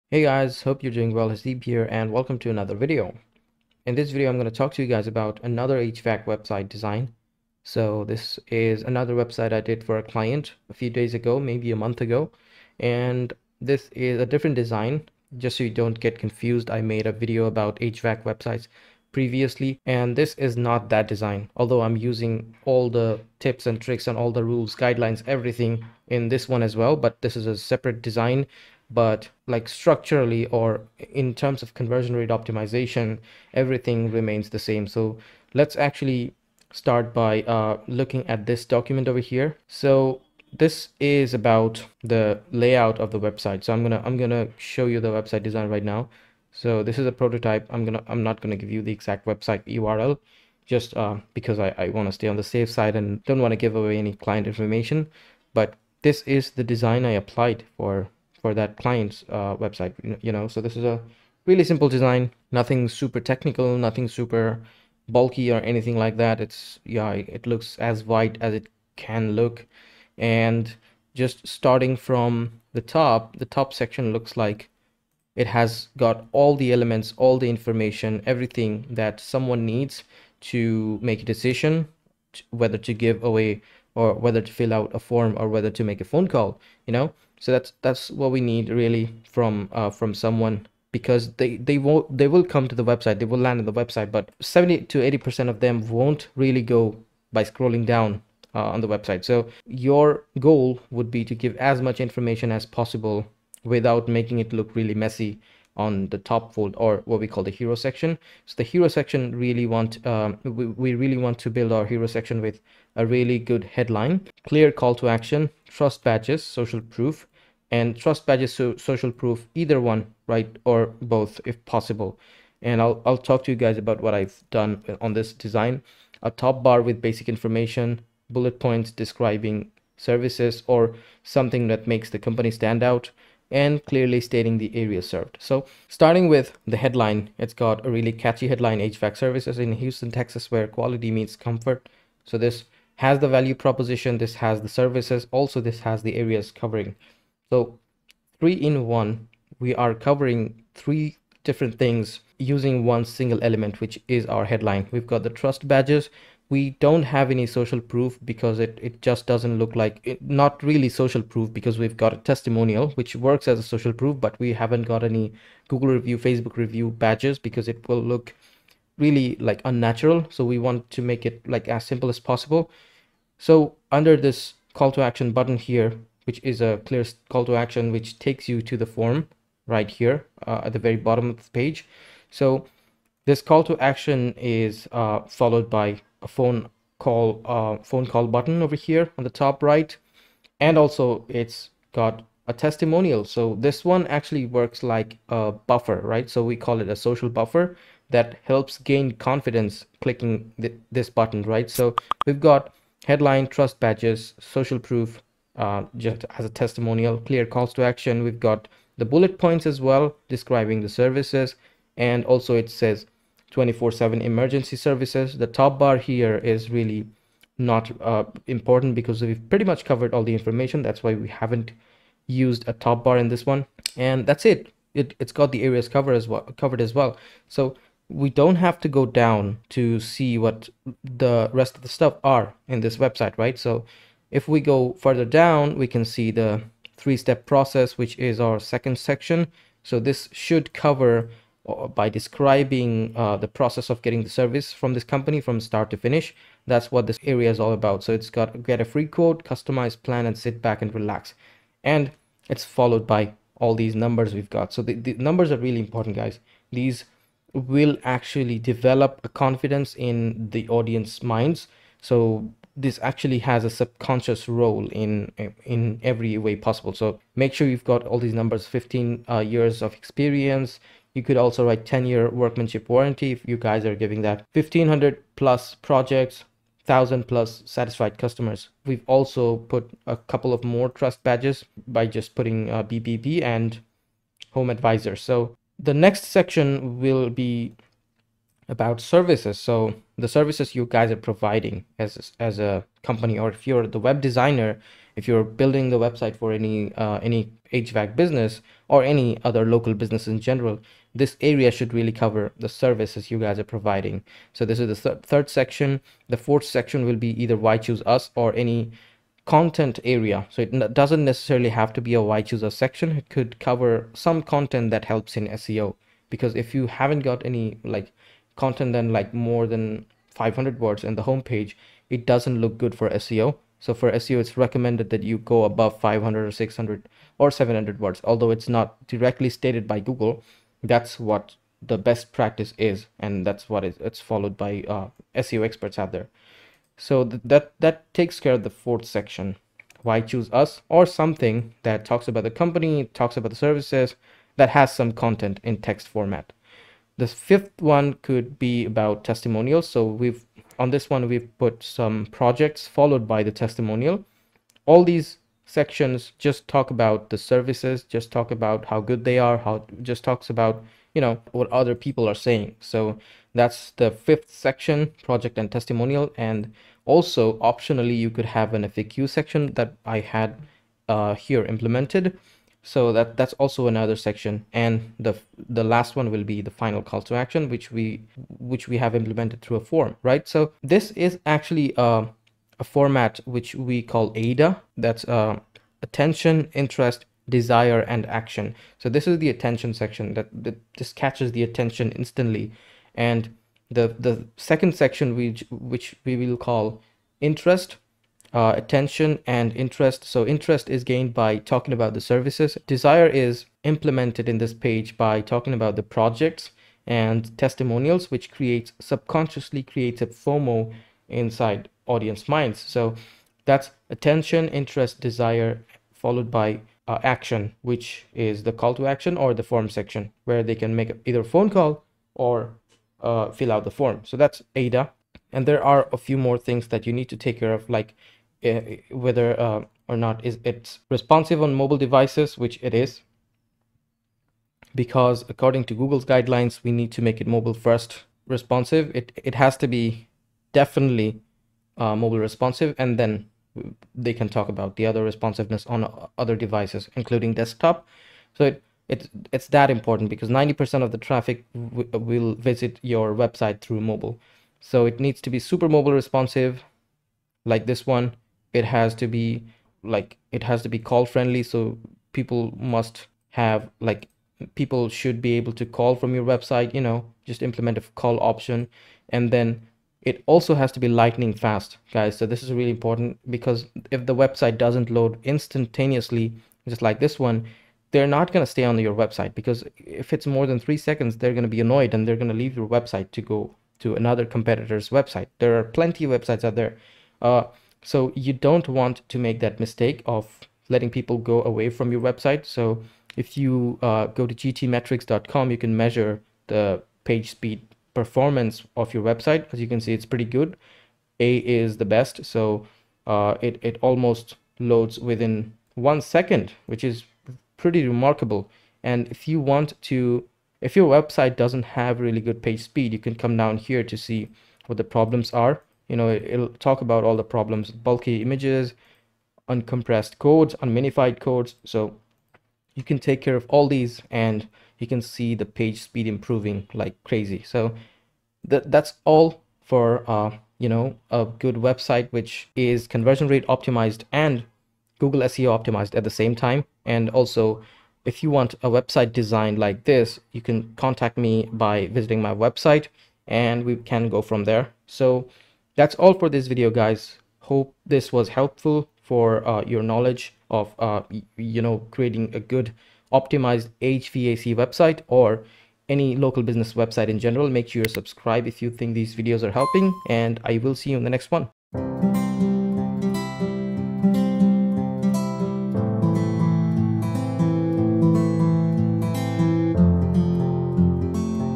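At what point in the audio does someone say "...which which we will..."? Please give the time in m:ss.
6:35.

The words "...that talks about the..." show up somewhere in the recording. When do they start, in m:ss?
5:41.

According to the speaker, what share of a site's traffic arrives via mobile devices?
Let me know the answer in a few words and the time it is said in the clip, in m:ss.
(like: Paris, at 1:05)
90%, at 7:30.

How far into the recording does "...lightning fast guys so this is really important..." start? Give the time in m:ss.
7:51.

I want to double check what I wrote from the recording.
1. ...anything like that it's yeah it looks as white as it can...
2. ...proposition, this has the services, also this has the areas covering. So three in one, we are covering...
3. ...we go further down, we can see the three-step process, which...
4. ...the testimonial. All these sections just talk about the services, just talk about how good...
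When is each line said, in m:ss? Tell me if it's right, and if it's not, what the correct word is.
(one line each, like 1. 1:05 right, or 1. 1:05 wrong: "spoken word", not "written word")
1. 1:05 right
2. 2:23 right
3. 3:54 right
4. 5:53 right.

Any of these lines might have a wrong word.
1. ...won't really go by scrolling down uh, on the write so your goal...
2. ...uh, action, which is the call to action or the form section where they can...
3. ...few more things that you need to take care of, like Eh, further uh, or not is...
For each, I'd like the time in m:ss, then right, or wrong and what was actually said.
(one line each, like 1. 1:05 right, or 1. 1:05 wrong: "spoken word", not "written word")
1. 1:35 wrong: "website", not "write"
2. 6:57 right
3. 7:06 wrong: "whether", not "further".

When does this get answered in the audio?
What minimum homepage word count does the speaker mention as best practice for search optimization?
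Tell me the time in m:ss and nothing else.
5:20.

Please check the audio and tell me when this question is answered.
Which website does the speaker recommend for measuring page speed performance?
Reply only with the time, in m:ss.
8:14.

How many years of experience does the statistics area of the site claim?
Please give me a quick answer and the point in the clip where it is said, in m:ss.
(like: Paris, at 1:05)
15, at 4:28.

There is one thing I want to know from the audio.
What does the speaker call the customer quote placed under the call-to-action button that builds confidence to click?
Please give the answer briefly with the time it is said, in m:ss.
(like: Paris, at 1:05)
social buffer, at 3:16.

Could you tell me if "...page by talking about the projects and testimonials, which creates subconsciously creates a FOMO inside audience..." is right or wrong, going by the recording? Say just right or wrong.
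right.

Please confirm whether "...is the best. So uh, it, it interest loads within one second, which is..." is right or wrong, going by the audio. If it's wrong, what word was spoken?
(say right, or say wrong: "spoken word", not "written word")
wrong: "almost", not "interest".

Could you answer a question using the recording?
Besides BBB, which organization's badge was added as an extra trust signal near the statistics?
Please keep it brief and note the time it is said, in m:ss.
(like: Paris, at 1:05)
HomeAdvisor, at 4:44.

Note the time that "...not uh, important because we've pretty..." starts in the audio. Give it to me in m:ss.
3:37.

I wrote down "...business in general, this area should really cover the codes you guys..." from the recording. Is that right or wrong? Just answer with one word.
wrong.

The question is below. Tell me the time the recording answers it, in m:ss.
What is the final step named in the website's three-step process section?
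4:10.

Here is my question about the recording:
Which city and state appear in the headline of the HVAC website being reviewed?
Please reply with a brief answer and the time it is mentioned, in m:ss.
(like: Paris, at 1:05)
Houston, Texas, at 2:19.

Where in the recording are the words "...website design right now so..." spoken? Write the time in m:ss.
0:45.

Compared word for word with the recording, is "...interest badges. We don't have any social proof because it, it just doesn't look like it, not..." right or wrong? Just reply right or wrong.
wrong.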